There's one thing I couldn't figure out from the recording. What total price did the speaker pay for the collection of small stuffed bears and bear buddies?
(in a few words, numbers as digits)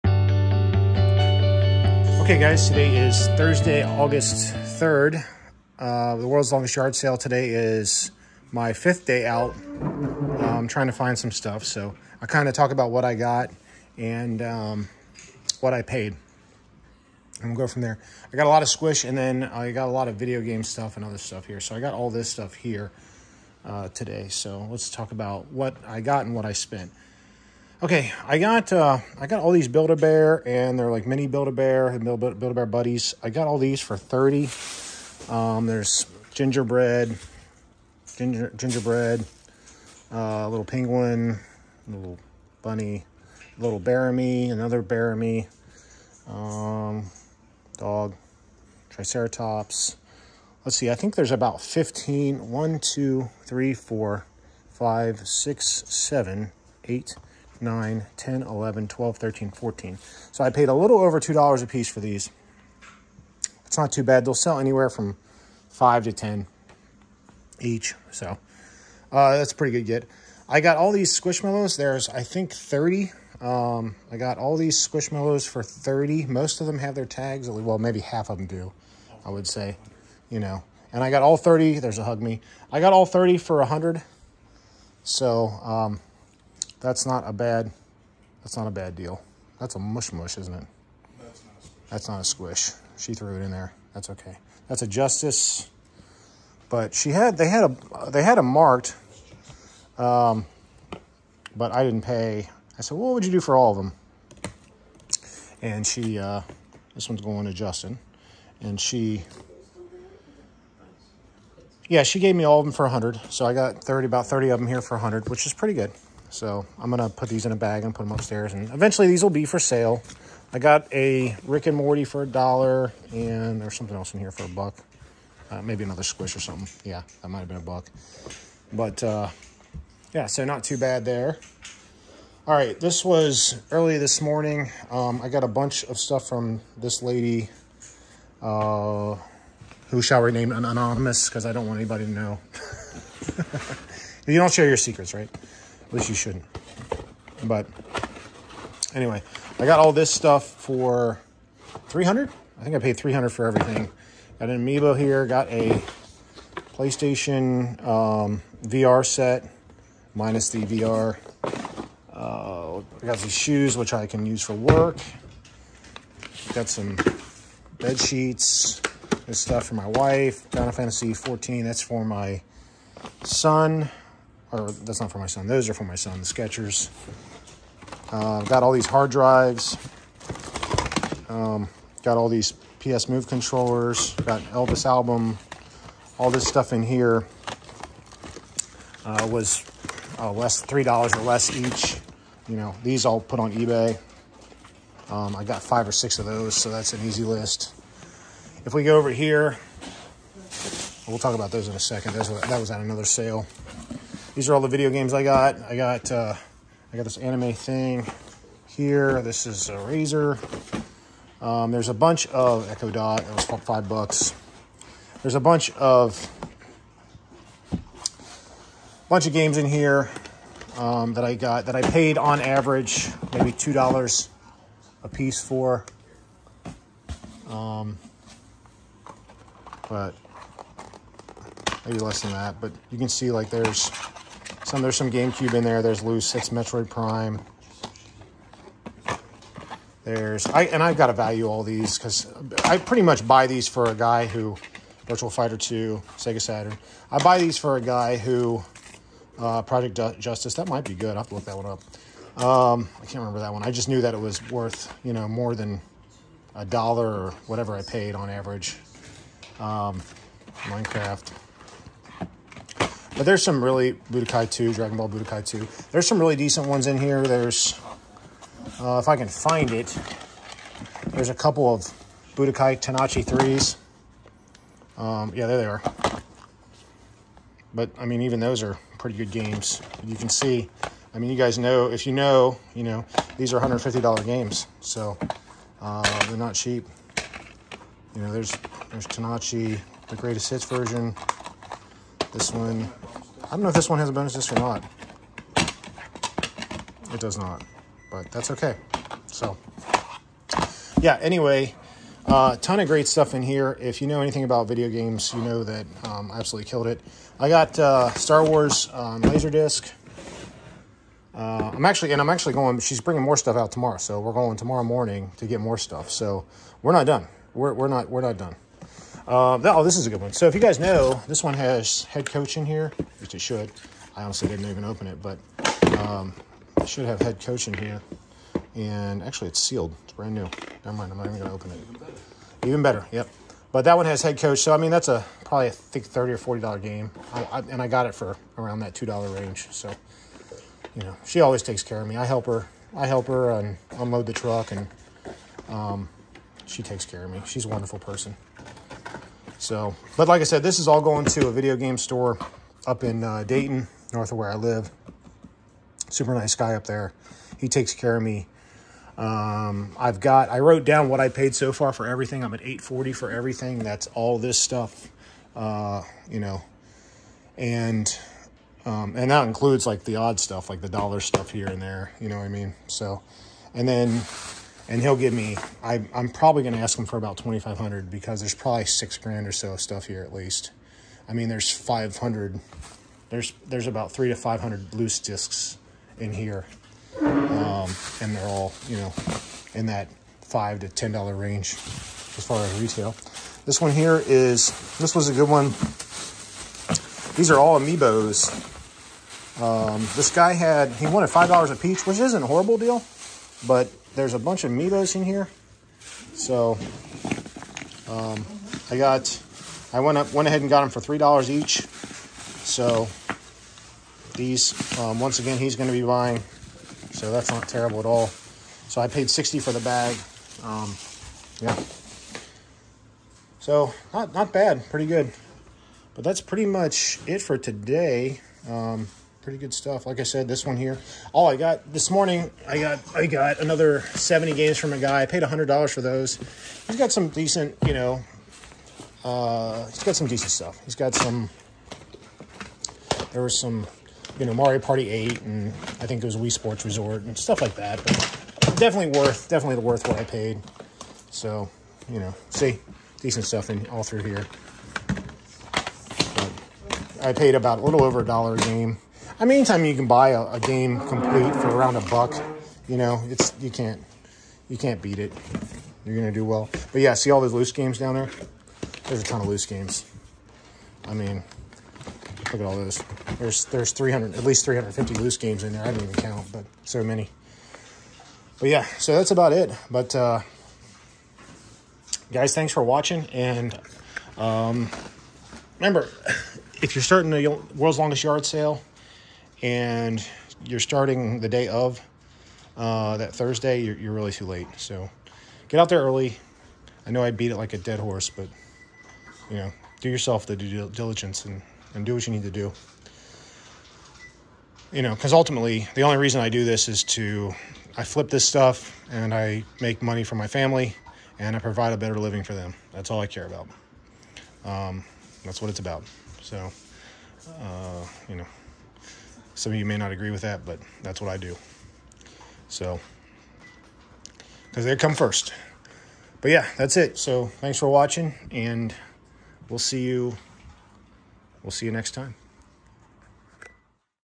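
30.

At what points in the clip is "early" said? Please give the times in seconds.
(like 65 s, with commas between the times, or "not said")
133 s, 496 s.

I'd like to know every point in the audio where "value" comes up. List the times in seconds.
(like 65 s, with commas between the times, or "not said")
241 s.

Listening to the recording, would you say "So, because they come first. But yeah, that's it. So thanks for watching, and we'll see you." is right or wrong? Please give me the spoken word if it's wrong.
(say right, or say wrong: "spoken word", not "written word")
right.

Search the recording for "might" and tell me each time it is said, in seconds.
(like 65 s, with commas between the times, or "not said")
127 s, 250 s.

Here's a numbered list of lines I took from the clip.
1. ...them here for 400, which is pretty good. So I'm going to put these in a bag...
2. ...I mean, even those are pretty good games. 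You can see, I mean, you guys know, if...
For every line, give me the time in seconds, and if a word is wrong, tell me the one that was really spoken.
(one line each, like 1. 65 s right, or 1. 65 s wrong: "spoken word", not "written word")
1. 114 s wrong: "100", not "400"
2. 277 s right.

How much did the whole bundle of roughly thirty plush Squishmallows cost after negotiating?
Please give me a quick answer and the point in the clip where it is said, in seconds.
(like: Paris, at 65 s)
100, at 82 s.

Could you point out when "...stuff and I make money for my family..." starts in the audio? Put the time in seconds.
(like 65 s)
508 s.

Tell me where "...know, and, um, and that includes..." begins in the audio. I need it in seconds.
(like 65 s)
366 s.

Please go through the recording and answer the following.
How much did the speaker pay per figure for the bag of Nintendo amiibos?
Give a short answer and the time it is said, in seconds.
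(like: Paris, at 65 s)
$3, at 410 s.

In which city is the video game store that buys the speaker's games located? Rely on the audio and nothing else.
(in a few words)
Dayton.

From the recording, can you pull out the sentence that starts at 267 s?
There's, uh, if I can find it, there's a couple of Budokai Tenkaichi 3s.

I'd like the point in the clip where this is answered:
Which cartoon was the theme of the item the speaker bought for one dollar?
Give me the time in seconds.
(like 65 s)
121 s.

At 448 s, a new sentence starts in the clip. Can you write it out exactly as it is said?
But definitely worth, definitely worth what I paid.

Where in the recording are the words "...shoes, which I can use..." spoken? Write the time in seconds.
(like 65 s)
163 s.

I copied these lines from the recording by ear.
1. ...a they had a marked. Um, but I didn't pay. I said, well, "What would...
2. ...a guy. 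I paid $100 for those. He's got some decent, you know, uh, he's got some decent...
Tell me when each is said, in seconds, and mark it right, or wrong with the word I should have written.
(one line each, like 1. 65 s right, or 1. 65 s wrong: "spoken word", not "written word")
1. 98 s right
2. 434 s right.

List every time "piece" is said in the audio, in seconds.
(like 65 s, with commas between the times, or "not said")
61 s, 225 s, 401 s.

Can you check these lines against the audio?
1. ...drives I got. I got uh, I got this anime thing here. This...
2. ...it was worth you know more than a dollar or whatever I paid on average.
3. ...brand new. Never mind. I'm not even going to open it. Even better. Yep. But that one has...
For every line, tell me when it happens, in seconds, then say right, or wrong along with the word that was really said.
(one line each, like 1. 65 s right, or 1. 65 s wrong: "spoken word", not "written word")
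1. 204 s wrong: "games", not "drives"
2. 254 s right
3. 330 s right.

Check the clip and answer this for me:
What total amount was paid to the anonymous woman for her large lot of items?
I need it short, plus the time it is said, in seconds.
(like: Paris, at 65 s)
300, at 152 s.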